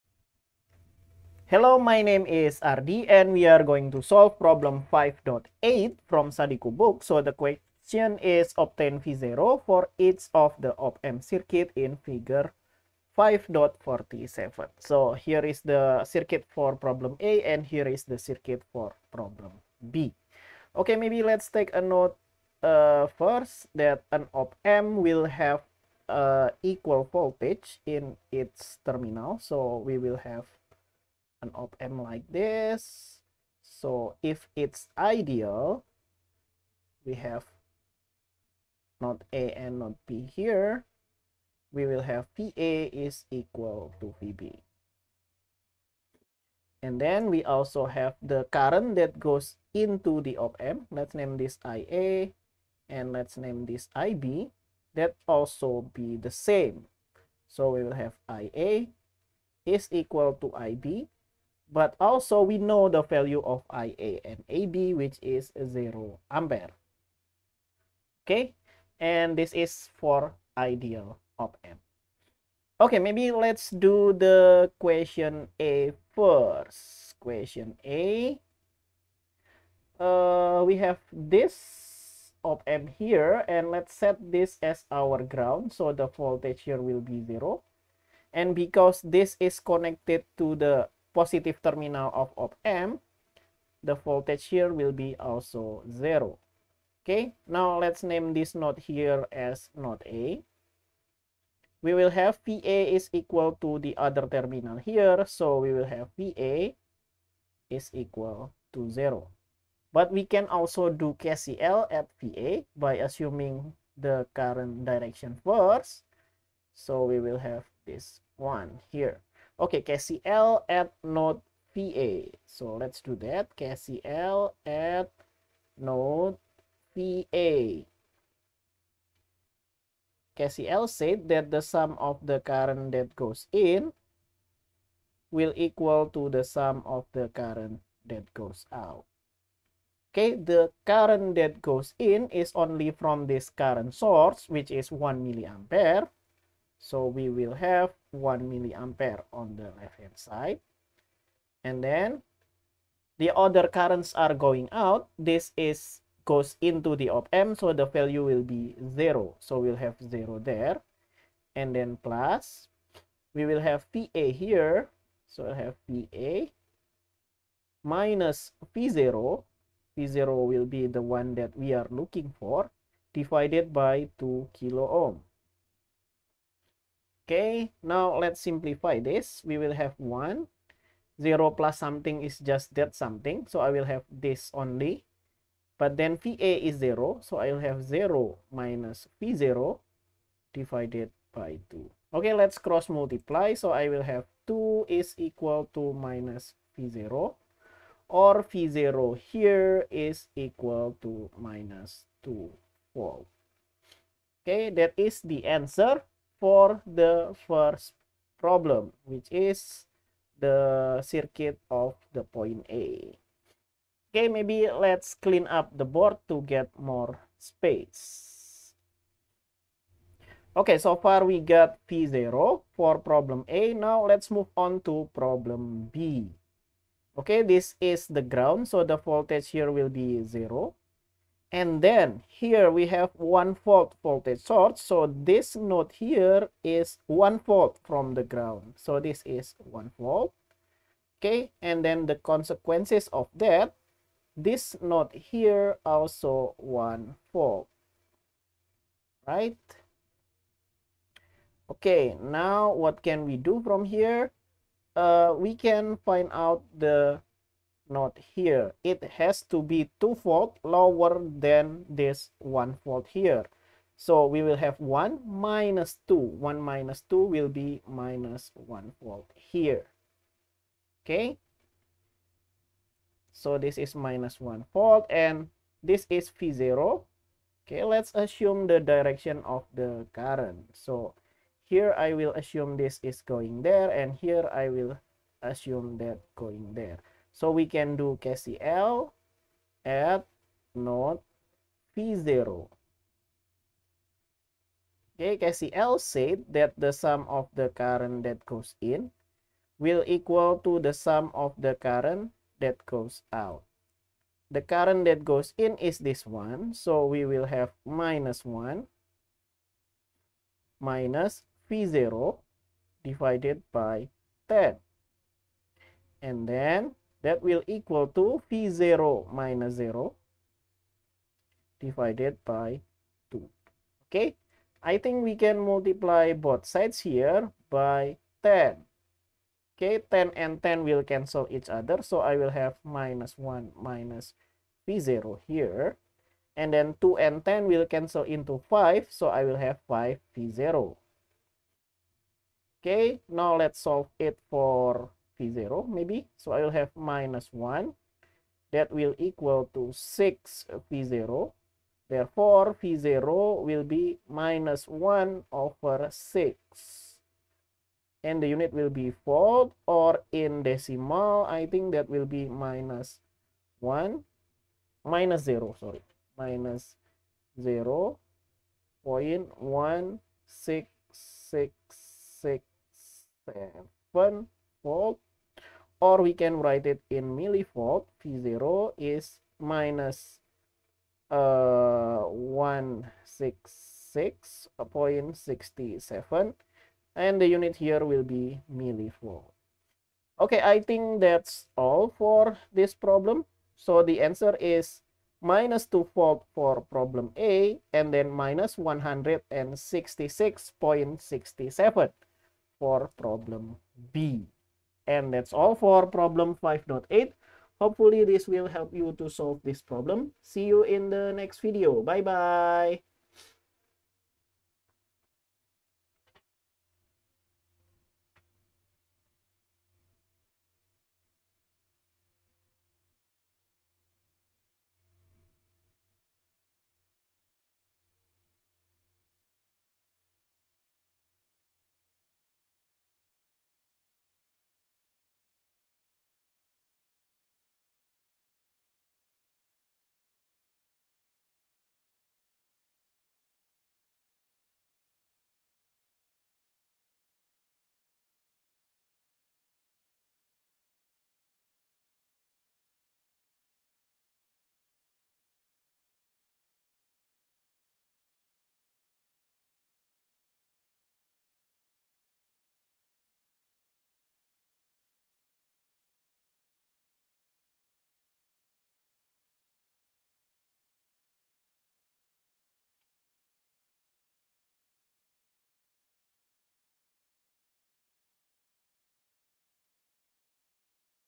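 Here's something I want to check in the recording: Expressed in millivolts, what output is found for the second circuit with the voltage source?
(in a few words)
-166.67 millivolt.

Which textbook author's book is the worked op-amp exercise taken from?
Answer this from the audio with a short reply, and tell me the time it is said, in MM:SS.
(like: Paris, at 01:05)
Sadiku, at 00:06.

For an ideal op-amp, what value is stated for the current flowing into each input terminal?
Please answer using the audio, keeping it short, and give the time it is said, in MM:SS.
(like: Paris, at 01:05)
0 ampere, at 01:05.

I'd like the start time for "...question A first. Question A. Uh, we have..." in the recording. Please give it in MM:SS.
01:14.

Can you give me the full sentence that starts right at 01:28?
And because this is connected to the positive terminal of op amp, the voltage here will be also 0.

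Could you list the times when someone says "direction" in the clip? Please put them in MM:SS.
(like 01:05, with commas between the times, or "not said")
01:54, 04:38.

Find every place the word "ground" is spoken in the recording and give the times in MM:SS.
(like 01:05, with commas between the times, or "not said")
01:25, 03:48, 03:58.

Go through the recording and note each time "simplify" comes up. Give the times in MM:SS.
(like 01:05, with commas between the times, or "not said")
02:58.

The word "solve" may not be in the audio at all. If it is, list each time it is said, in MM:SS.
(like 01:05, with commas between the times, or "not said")
00:04, 05:43, 06:49.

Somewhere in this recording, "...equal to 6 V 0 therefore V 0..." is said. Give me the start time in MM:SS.
05:49.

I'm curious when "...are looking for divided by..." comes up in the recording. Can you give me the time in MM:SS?
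02:51.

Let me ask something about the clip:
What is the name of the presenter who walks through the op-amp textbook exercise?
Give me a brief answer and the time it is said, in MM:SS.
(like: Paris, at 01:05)
Ardi, at 00:02.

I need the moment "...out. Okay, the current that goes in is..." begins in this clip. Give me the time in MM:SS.
02:18.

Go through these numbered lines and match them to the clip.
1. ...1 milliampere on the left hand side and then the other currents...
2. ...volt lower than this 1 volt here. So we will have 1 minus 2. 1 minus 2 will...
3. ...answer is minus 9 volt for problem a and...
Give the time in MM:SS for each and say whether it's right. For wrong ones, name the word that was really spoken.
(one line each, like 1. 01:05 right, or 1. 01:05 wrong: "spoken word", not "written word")
1. 02:28 right
2. 04:20 right
3. 06:34 wrong: "2", not "9".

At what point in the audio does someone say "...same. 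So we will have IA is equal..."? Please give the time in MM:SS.
00:56.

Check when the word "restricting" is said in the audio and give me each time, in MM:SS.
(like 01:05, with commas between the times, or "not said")
not said.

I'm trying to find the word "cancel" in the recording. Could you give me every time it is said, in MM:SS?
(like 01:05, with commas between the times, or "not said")
05:31, 05:37.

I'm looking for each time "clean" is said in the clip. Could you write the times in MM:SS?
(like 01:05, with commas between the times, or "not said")
03:35.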